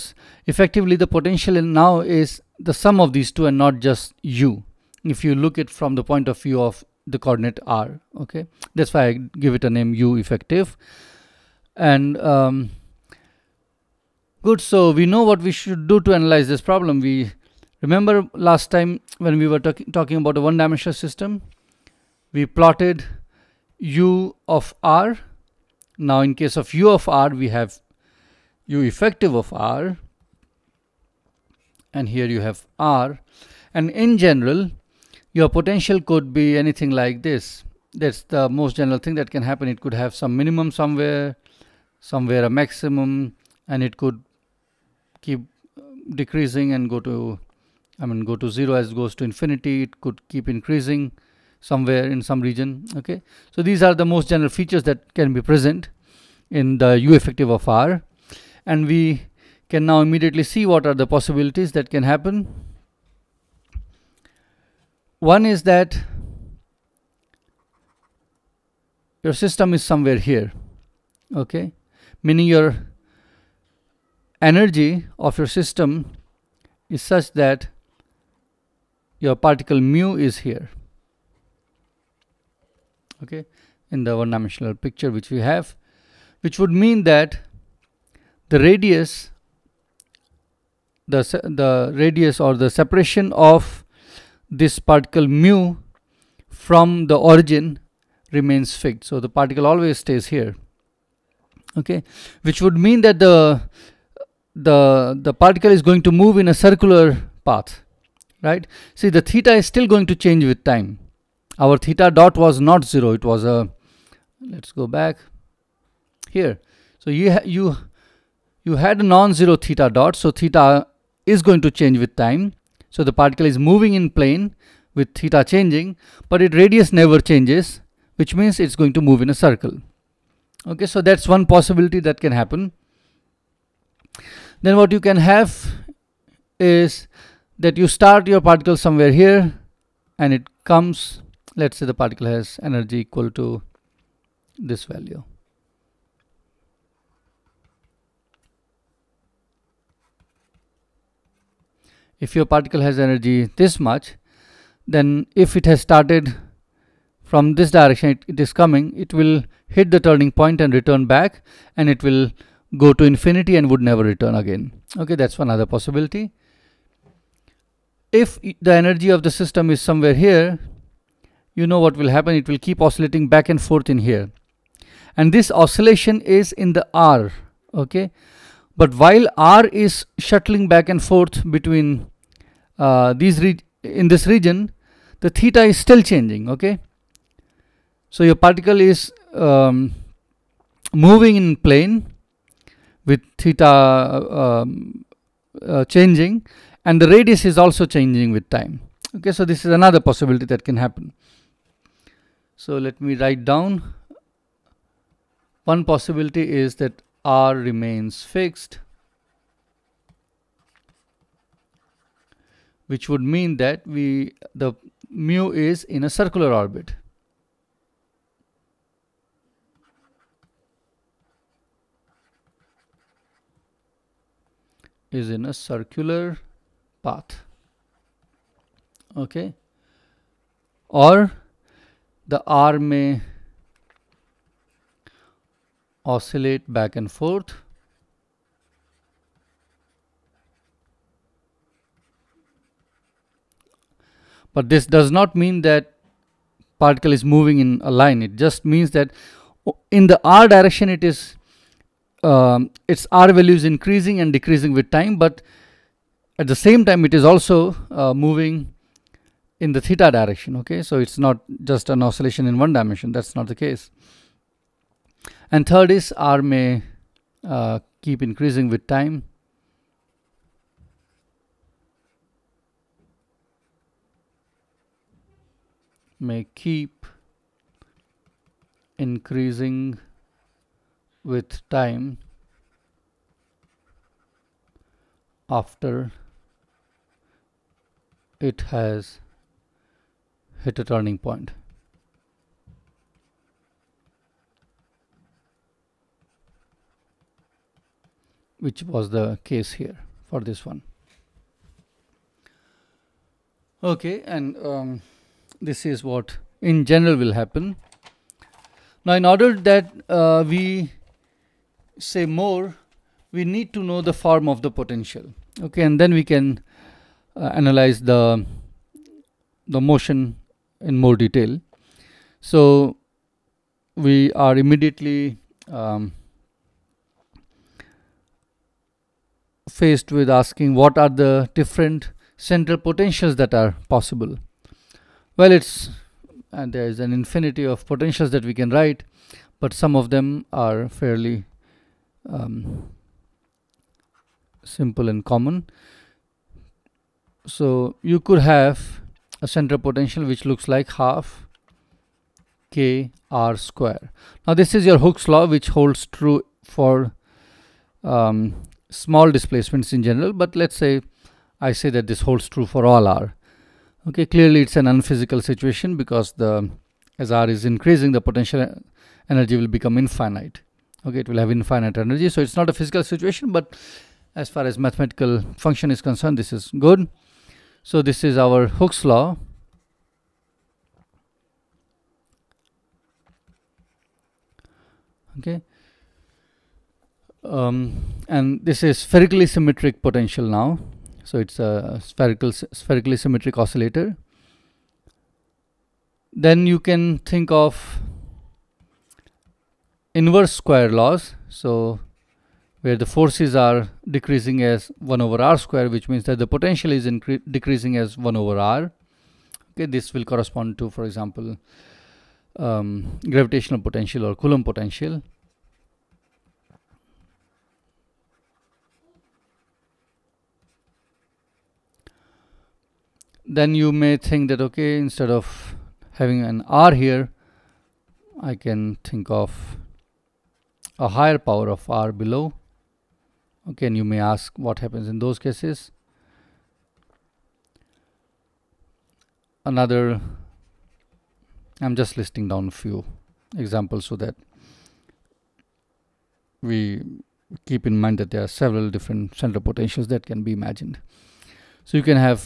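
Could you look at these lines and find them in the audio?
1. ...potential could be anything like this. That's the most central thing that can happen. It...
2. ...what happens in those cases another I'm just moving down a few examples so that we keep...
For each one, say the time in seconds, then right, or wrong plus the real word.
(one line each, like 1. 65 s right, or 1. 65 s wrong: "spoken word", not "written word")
1. 35 s wrong: "general", not "central"
2. 434 s wrong: "listing", not "moving".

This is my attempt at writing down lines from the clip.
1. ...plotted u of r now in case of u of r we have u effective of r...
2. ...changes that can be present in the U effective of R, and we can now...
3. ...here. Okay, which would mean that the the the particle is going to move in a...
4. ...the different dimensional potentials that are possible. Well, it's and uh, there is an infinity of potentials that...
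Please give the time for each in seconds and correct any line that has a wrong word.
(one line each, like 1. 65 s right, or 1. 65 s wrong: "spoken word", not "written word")
1. 22 s right
2. 54 s wrong: "features", not "changes"
3. 100 s right
4. 331 s wrong: "central", not "dimensional".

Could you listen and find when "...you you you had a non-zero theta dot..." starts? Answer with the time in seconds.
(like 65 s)
117 s.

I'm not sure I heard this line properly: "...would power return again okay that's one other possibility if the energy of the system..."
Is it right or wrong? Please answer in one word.
wrong.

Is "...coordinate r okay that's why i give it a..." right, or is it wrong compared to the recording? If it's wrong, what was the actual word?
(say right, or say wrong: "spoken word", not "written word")
right.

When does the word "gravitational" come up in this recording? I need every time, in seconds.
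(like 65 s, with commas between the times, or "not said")
413 s.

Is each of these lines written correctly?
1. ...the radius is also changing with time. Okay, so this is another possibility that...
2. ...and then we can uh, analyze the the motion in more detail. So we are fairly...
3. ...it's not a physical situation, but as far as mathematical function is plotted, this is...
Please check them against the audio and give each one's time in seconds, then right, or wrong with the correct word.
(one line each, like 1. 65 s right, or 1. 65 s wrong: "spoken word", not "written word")
1. 197 s right
2. 315 s wrong: "immediately", not "fairly"
3. 372 s wrong: "concerned", not "plotted".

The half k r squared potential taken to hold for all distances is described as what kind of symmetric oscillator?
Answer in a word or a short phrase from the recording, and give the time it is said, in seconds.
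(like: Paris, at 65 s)
Spherically symmetric oscillator, at 392 s.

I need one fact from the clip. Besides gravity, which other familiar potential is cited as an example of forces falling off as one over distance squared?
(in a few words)
Coulomb potential.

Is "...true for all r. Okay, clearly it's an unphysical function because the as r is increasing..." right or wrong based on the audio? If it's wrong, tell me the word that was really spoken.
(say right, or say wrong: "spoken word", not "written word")
wrong: "situation", not "function".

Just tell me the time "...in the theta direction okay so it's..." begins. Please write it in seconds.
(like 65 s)
259 s.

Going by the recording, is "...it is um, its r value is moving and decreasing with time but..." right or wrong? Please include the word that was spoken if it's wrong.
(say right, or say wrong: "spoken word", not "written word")
wrong: "increasing", not "moving".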